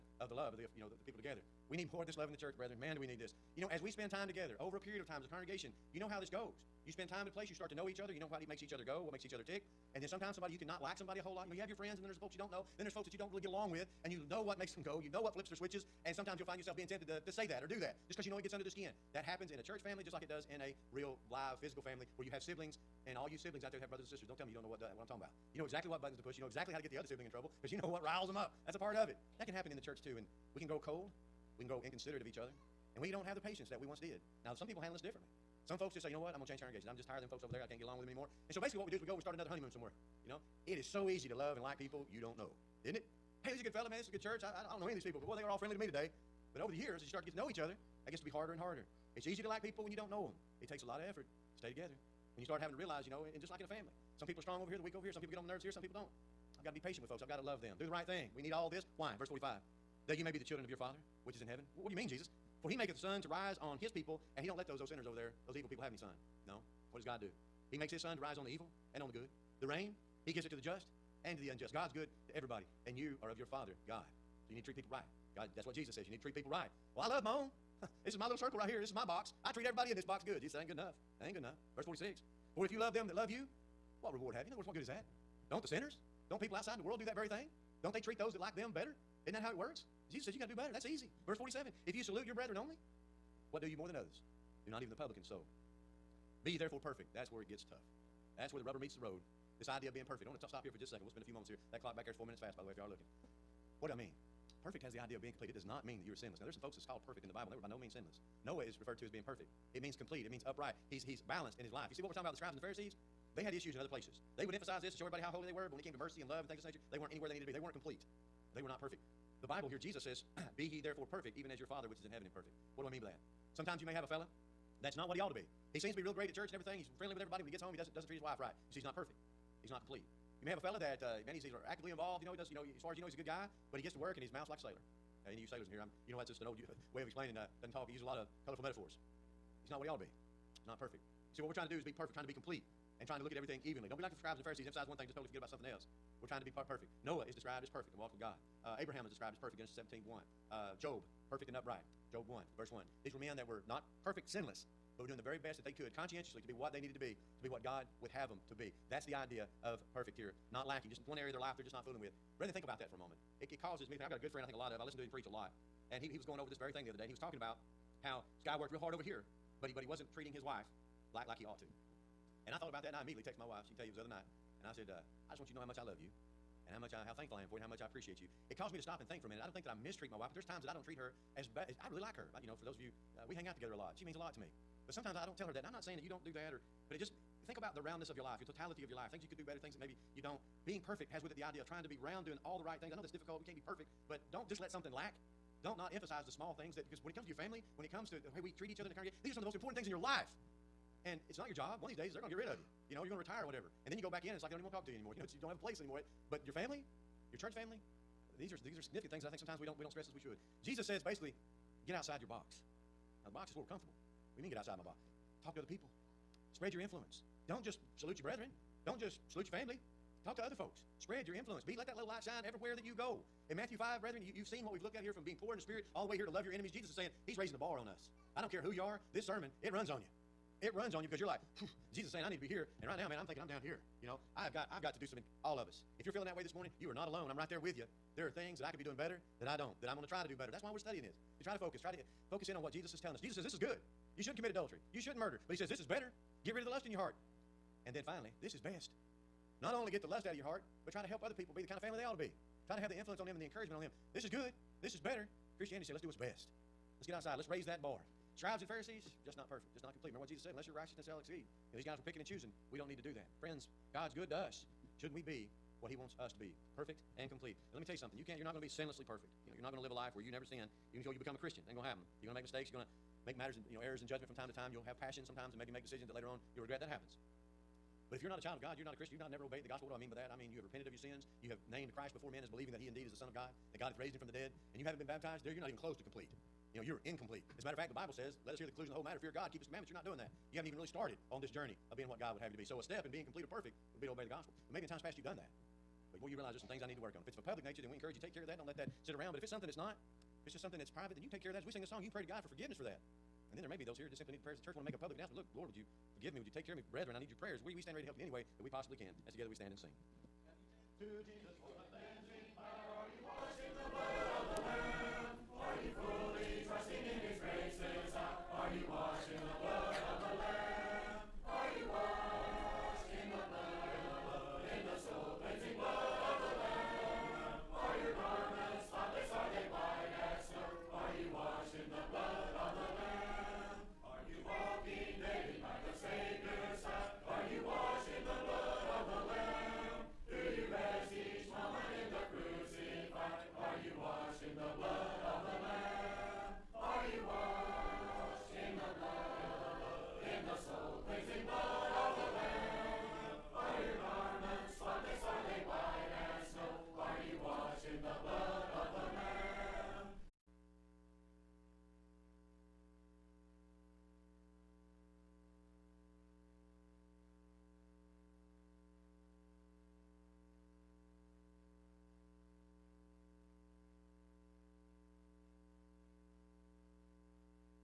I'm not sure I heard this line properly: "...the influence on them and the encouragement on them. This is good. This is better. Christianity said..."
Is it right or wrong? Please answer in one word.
right.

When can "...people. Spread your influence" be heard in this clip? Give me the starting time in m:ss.
3:35.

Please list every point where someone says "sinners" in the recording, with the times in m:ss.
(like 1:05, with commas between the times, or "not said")
1:04, 1:25.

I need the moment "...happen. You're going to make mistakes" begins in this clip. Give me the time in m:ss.
4:31.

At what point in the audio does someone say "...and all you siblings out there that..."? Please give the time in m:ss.
0:23.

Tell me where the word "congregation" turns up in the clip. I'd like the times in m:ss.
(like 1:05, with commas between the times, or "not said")
0:05, 0:36, 3:18.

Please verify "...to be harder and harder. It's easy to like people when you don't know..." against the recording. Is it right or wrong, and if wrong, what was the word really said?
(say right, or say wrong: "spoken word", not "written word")
right.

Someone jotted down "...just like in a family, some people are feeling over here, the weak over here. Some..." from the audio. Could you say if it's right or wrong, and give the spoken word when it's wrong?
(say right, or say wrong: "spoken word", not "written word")
wrong: "strong", not "feeling".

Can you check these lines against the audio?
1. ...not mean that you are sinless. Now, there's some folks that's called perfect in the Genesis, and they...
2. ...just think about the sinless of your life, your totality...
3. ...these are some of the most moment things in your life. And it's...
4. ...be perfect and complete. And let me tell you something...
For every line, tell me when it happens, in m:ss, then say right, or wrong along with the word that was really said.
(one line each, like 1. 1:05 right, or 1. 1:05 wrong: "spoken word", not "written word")
1. 1:45 wrong: "Bible", not "Genesis"
2. 3:06 wrong: "roundness", not "sinless"
3. 3:19 wrong: "important", not "moment"
4. 4:26 right.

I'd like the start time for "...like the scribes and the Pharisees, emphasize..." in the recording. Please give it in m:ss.
2:24.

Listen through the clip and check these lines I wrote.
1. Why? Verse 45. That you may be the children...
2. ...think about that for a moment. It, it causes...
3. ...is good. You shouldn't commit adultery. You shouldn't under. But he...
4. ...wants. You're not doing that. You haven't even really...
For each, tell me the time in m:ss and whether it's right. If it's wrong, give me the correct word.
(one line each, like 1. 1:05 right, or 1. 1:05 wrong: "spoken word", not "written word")
1. 0:58 right
2. 2:42 right
3. 4:03 wrong: "murder", not "under"
4. 4:49 wrong: "commandments", not "wants".